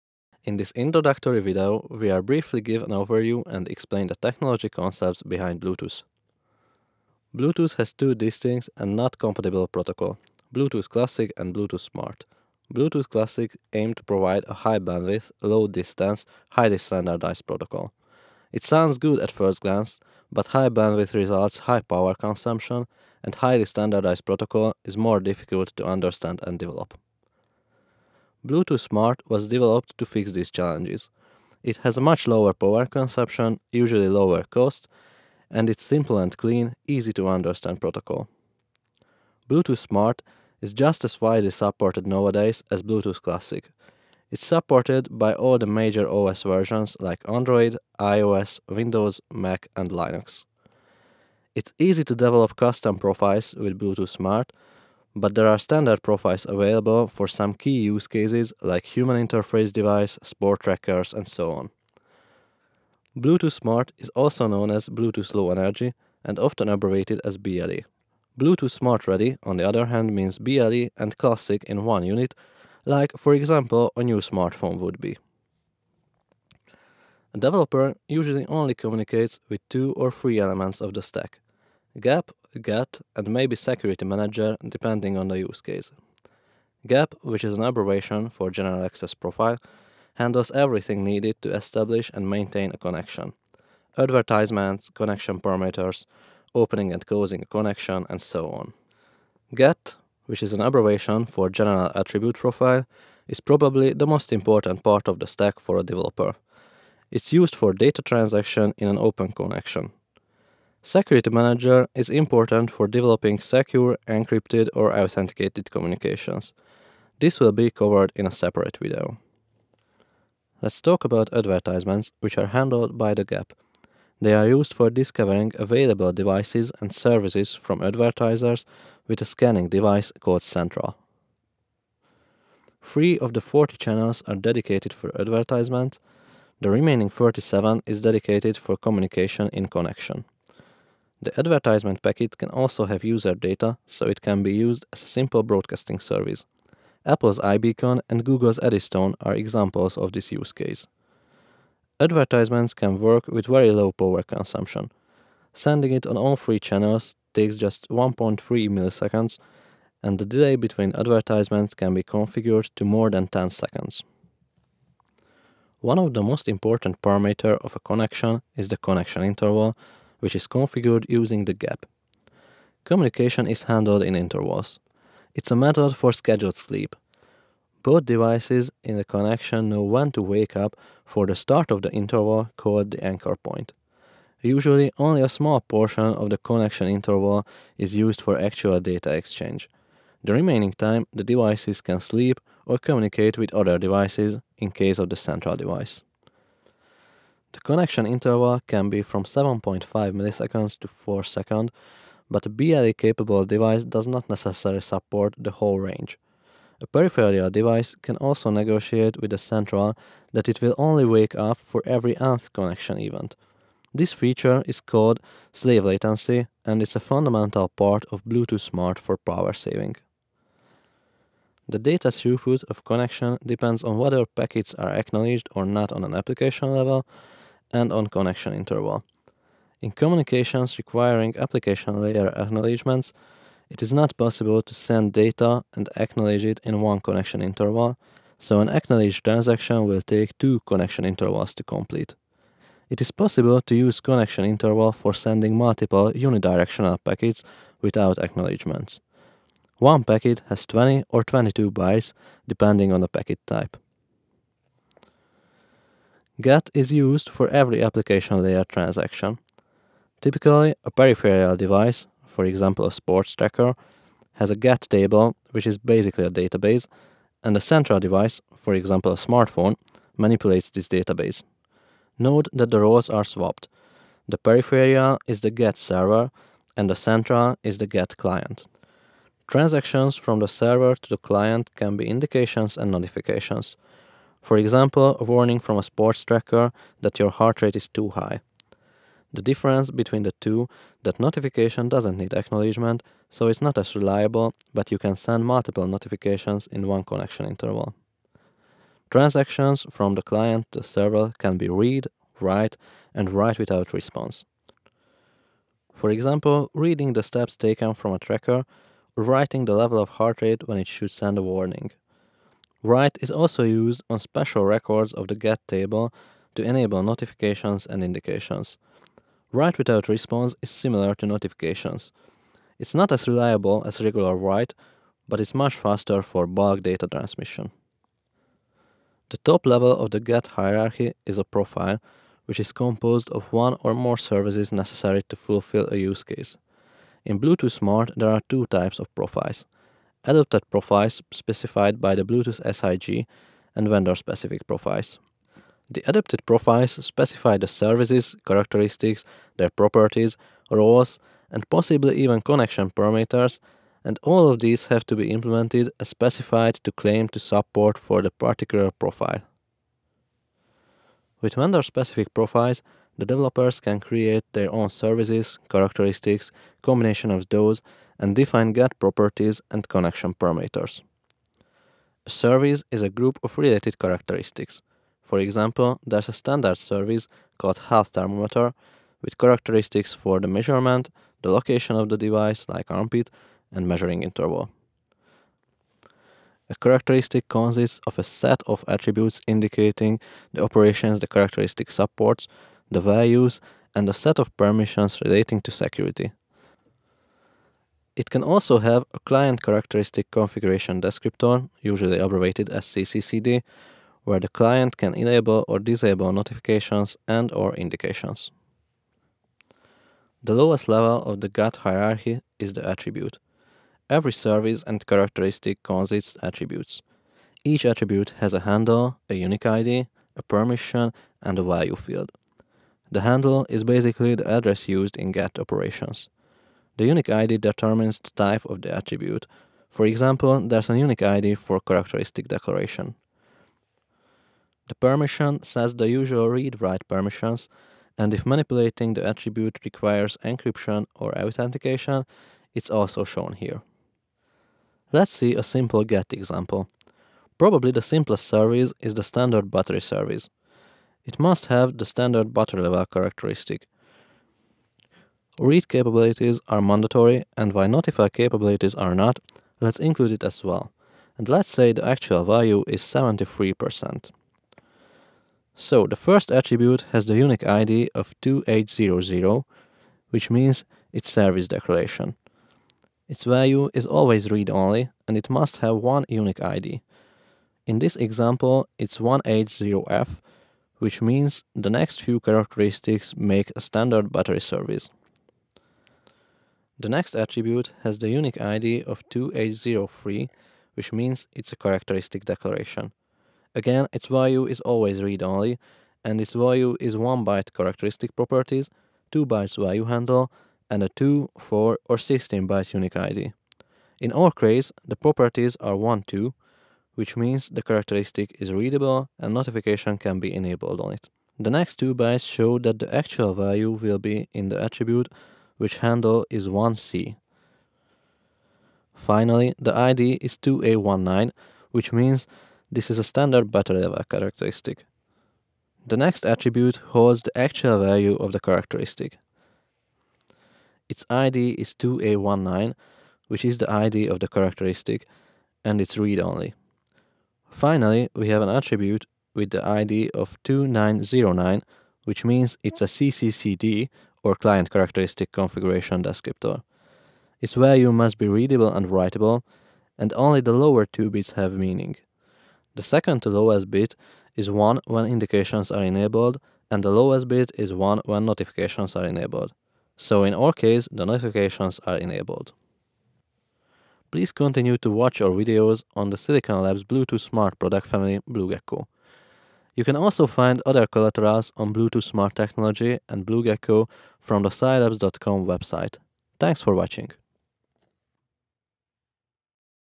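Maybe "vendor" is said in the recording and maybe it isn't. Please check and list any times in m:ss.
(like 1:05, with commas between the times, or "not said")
5:43, 6:01.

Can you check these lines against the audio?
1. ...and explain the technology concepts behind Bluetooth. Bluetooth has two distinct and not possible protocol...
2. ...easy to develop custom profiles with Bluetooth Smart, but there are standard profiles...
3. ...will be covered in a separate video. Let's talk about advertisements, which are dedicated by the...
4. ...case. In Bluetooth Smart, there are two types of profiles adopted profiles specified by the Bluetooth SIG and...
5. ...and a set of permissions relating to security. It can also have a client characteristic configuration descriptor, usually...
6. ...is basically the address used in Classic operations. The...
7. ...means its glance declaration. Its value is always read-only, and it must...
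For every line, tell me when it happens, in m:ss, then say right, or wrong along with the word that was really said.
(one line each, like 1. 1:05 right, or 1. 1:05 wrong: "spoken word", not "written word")
1. 0:03 wrong: "compatible", not "possible"
2. 0:51 right
3. 1:57 wrong: "handled", not "dedicated"
4. 5:36 right
5. 6:33 right
6. 7:03 wrong: "GATT", not "Classic"
7. 7:50 wrong: "service", not "glance".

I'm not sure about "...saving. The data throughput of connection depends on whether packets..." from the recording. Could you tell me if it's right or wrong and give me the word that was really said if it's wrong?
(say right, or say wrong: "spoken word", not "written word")
right.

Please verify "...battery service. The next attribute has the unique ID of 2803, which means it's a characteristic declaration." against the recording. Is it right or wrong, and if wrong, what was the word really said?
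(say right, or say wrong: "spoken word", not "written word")
right.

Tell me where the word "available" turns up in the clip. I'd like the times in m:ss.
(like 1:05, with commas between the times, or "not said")
0:56, 2:05.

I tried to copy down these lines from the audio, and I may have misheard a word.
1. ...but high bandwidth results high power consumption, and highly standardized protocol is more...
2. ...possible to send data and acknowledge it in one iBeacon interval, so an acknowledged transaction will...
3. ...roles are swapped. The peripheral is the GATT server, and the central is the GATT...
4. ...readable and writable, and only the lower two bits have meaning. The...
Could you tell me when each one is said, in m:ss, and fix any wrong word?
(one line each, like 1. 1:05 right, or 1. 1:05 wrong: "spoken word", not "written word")
1. 0:20 right
2. 3:54 wrong: "connection", not "iBeacon"
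3. 4:32 right
4. 9:08 right.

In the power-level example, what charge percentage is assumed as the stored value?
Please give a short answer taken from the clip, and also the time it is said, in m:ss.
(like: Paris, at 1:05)
73%, at 7:43.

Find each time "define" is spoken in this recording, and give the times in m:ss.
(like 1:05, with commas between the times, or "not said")
6:08.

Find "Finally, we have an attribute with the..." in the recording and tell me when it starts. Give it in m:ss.
8:57.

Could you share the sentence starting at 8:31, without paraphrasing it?
The next two bytes show that the actual value will be in the attribute which handle is 1C.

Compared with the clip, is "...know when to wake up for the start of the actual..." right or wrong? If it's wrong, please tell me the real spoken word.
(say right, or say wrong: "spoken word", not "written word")
wrong: "interval", not "actual".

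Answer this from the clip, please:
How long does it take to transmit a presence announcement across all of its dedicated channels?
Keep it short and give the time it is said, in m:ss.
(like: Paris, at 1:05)
1.3 milliseconds, at 2:37.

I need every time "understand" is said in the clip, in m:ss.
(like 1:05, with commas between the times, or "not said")
0:25, 0:37.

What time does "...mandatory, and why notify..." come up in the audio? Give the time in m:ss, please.
7:36.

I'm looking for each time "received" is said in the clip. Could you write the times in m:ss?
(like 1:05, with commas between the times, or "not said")
not said.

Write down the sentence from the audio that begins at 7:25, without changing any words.
Let's see a simple GATT example.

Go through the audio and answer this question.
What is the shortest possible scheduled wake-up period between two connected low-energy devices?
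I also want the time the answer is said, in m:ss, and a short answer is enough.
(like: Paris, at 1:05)
7.5 milliseconds, at 3:19.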